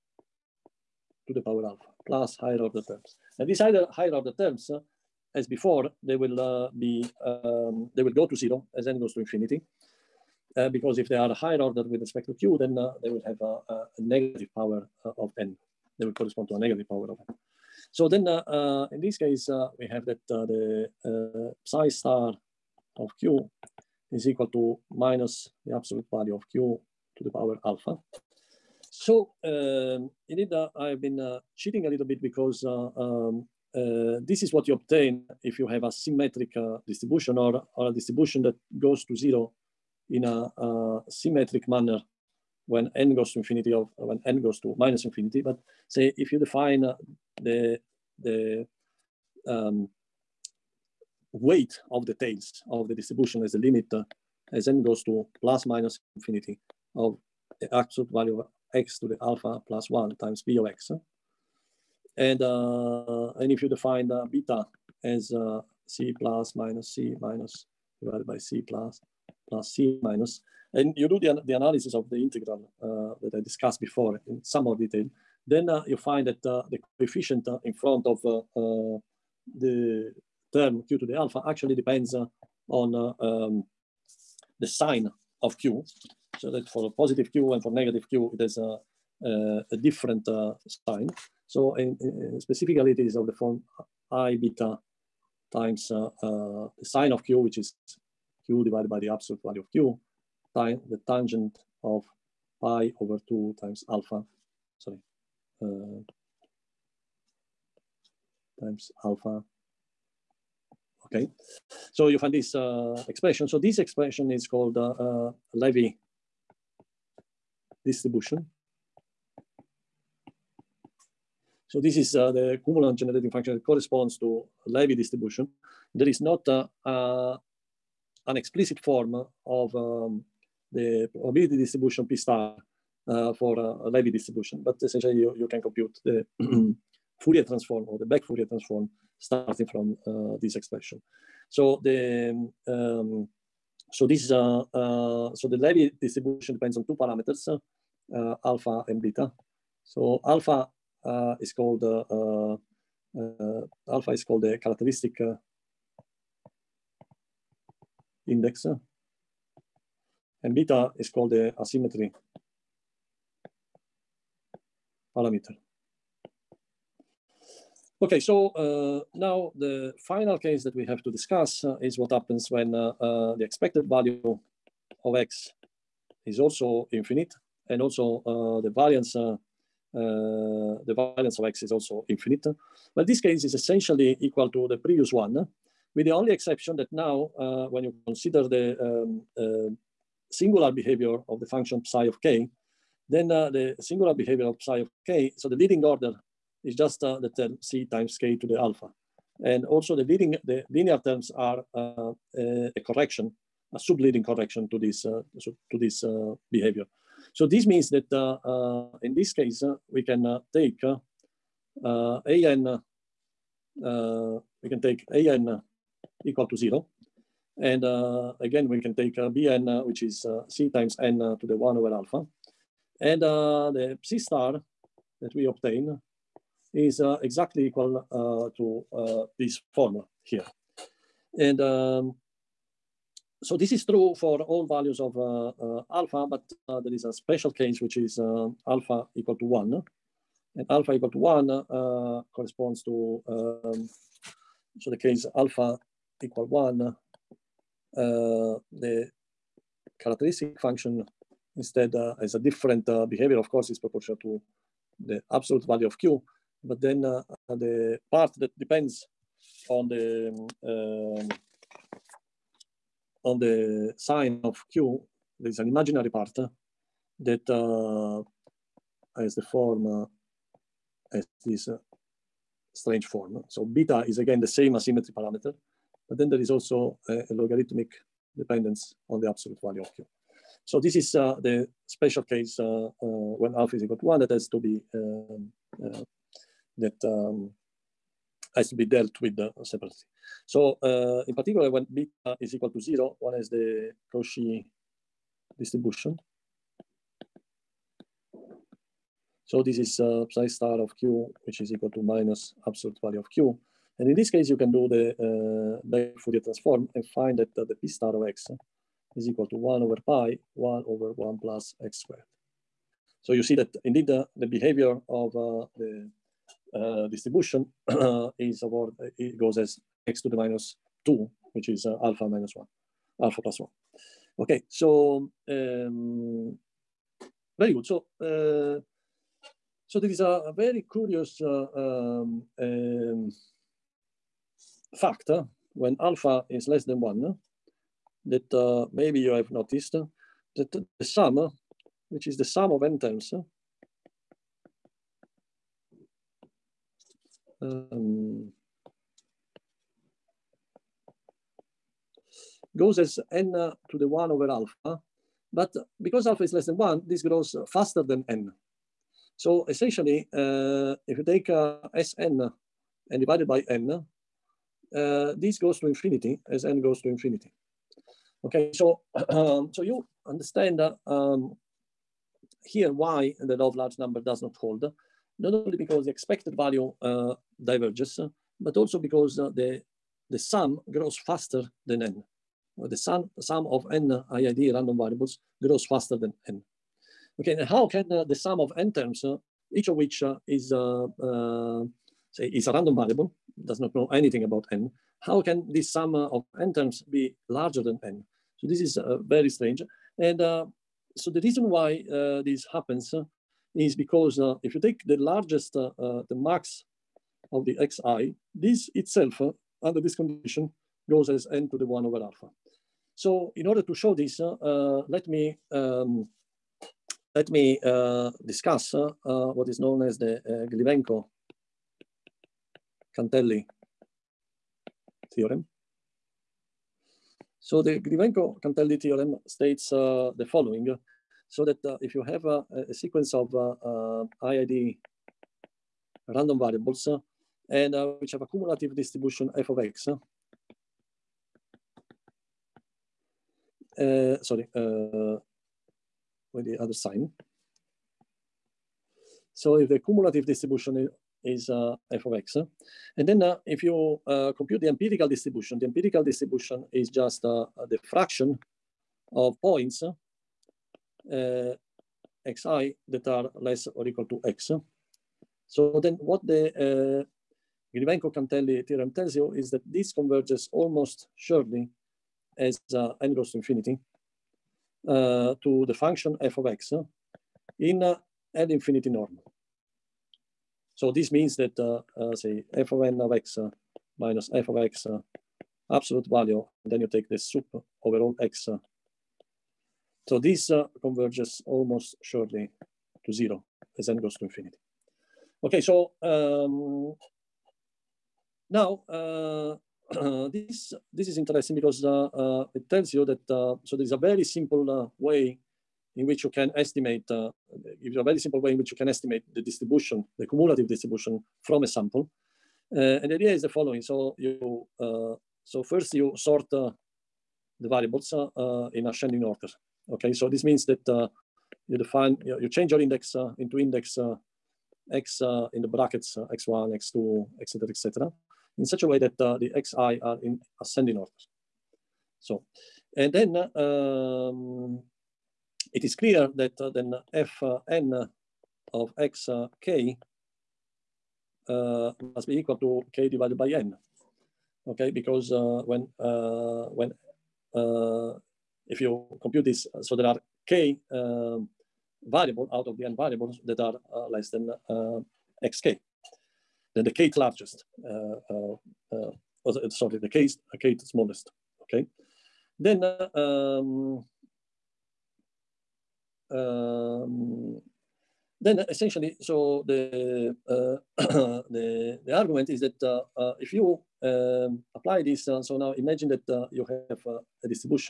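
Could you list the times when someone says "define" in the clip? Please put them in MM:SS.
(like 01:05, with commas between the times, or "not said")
00:46, 01:03, 08:41.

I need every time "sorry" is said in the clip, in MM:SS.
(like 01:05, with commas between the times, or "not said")
01:44, 07:24, 09:19.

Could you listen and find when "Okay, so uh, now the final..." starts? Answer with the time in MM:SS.
02:48.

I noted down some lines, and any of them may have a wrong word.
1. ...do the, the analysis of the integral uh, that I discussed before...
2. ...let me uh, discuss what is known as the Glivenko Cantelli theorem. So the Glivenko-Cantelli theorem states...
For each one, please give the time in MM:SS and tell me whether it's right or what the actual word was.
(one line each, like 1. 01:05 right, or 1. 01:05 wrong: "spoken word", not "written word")
1. 01:11 right
2. 06:57 right.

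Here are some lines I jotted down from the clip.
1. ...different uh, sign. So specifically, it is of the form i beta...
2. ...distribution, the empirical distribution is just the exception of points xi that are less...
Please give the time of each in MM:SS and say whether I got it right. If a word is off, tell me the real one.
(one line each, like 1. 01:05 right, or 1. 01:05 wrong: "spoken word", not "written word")
1. 01:29 right
2. 07:35 wrong: "fraction", not "exception".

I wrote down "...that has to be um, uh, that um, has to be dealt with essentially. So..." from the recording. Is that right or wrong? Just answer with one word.
wrong.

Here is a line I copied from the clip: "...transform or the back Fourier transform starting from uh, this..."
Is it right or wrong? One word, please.
right.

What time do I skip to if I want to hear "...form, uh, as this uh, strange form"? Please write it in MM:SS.
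04:29.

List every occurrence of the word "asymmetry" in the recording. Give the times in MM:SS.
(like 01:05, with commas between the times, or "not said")
02:41, 04:34.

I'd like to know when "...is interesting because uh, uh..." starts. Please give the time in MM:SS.
08:21.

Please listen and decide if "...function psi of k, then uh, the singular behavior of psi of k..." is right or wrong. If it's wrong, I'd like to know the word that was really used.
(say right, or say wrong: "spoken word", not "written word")
right.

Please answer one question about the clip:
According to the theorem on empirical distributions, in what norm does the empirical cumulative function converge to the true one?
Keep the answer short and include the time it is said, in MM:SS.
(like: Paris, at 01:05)
infinity norm, at 07:58.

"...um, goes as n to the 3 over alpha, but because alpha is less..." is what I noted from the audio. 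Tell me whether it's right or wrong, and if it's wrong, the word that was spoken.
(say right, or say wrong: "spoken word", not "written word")
wrong: "1", not "3".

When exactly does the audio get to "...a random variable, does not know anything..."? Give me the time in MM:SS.
06:32.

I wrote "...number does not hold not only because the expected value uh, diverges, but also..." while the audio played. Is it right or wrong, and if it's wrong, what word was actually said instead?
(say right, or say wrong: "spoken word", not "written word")
right.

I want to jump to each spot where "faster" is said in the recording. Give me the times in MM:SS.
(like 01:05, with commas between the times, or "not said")
05:57, 06:21, 06:25.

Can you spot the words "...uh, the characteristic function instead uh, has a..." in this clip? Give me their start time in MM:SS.
04:07.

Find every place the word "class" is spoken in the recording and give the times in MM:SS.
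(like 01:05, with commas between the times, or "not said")
not said.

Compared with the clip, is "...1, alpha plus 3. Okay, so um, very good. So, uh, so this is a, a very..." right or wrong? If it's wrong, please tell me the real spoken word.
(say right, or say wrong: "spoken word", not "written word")
wrong: "1", not "3".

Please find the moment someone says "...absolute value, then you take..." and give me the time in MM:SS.
08:05.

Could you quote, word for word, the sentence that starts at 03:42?
And the C star that we obtain is uh, exactly equal uh, to uh, this formula here.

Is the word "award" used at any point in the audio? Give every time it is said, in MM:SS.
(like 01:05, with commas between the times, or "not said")
05:18.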